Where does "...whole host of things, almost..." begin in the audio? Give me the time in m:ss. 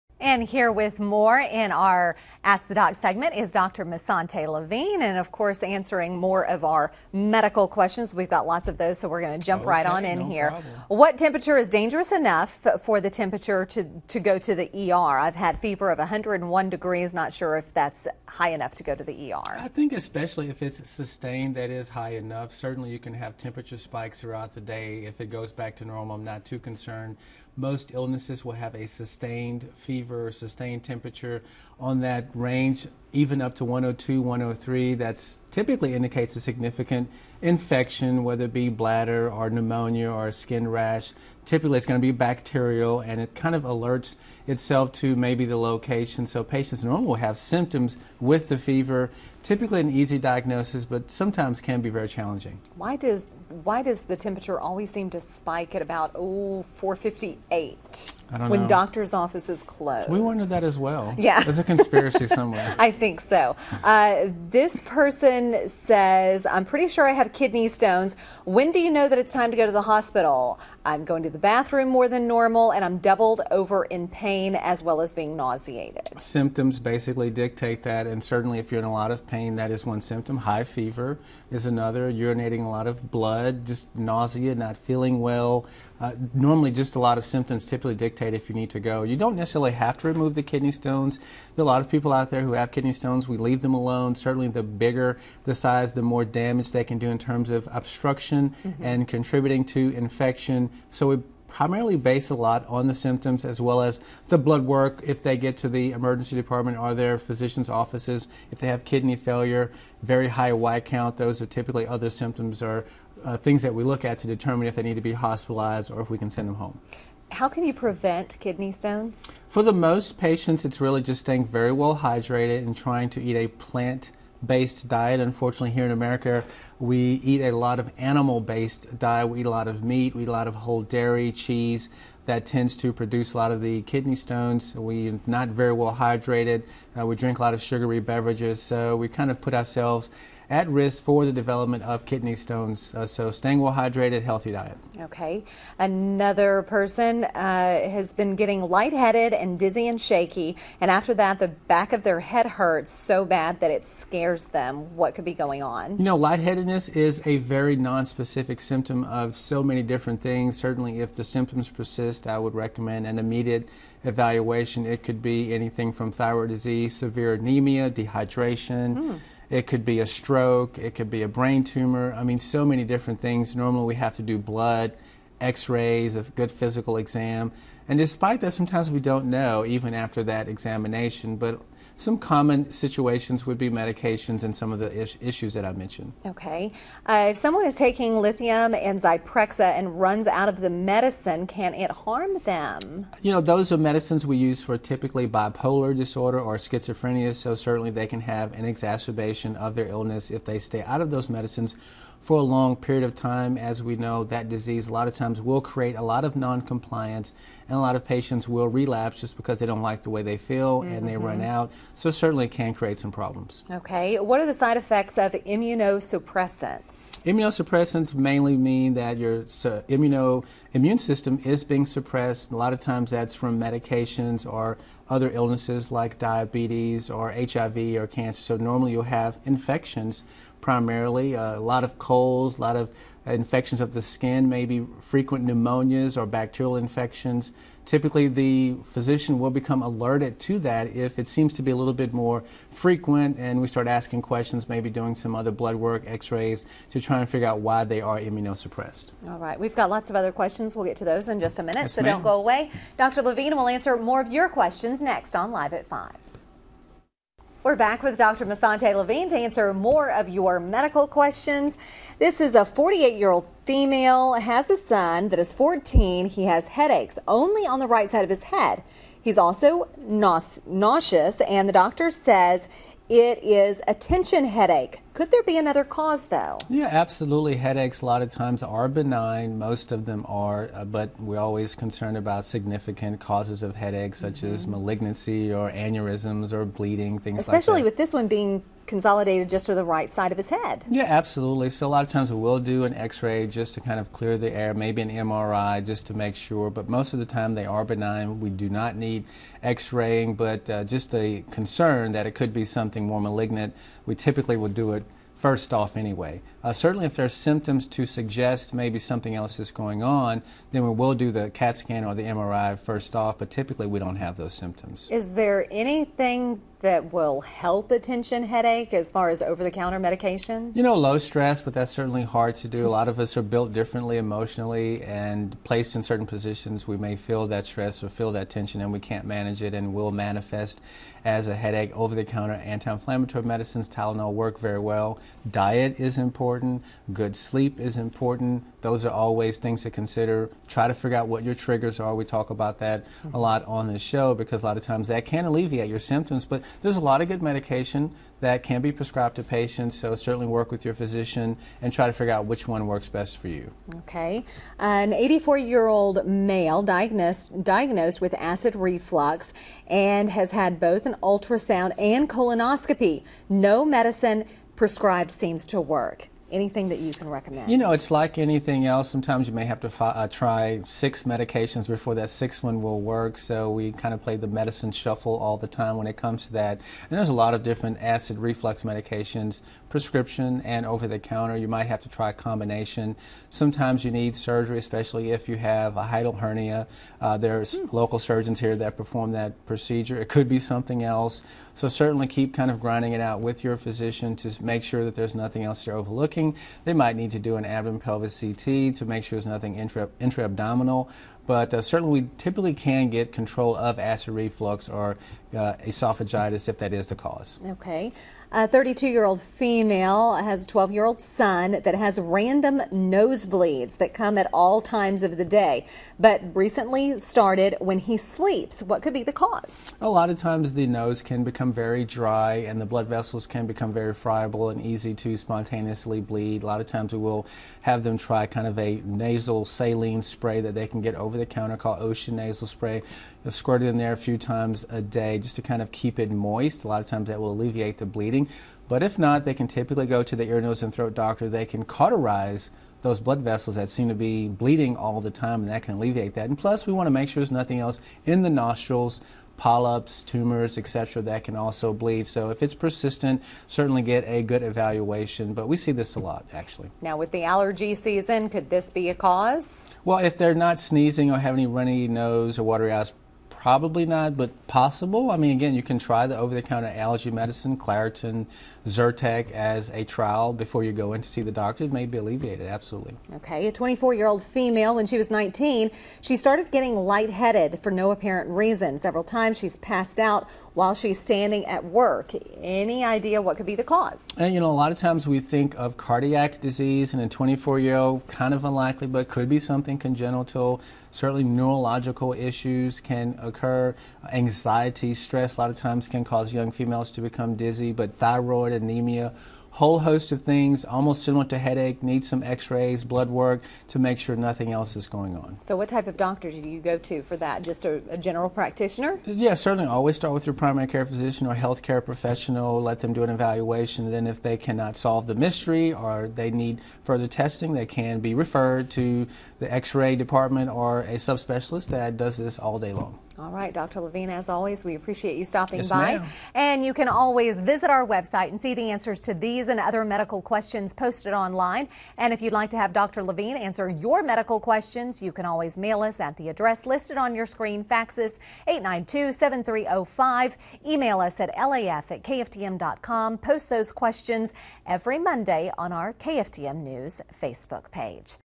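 8:19.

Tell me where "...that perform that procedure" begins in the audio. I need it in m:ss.
6:28.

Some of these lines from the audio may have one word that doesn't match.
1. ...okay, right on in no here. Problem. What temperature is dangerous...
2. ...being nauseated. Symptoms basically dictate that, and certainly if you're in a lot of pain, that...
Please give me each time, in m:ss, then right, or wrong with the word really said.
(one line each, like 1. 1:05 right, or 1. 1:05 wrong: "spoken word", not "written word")
1. 0:09 right
2. 1:15 right.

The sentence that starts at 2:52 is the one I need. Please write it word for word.
I mean, so many different things.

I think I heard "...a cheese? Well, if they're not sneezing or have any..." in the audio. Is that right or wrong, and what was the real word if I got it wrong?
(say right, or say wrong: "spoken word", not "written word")
wrong: "cause", not "cheese".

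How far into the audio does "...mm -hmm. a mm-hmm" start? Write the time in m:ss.
5:43.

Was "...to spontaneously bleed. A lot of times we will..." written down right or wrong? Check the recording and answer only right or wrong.
right.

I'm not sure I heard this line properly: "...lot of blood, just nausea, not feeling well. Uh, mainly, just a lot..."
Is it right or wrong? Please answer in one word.
wrong.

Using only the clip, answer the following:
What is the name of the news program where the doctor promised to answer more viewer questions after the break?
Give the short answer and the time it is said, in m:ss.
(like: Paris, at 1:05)
Live at 5, at 4:15.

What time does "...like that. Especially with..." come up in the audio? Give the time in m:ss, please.
4:47.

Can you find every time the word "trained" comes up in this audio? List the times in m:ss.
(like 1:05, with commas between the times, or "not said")
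not said.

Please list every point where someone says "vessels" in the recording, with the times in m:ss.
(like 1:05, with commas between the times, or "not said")
7:03, 7:23.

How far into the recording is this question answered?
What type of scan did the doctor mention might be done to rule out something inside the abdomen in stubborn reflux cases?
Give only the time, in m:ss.
6:37.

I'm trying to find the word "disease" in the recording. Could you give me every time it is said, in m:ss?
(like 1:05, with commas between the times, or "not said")
2:46, 3:24, 8:06.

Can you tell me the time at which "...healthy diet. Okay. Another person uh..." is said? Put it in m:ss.
2:24.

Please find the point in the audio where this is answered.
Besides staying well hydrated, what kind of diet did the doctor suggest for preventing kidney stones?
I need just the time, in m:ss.
2:03.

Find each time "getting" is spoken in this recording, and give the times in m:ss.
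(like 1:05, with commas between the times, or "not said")
2:28, 7:56.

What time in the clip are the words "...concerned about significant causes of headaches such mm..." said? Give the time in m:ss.
4:41.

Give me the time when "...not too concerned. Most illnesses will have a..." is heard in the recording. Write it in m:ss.
0:26.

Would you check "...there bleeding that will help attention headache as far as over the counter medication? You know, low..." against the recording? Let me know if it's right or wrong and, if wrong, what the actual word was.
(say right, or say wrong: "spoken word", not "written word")
wrong: "anything", not "bleeding".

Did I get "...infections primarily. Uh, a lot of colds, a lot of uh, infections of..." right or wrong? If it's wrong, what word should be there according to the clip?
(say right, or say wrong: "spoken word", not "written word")
right.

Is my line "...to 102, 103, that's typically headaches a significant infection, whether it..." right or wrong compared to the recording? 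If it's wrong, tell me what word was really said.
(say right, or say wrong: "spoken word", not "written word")
wrong: "indicates", not "headaches".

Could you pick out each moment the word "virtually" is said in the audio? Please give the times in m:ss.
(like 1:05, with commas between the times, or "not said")
not said.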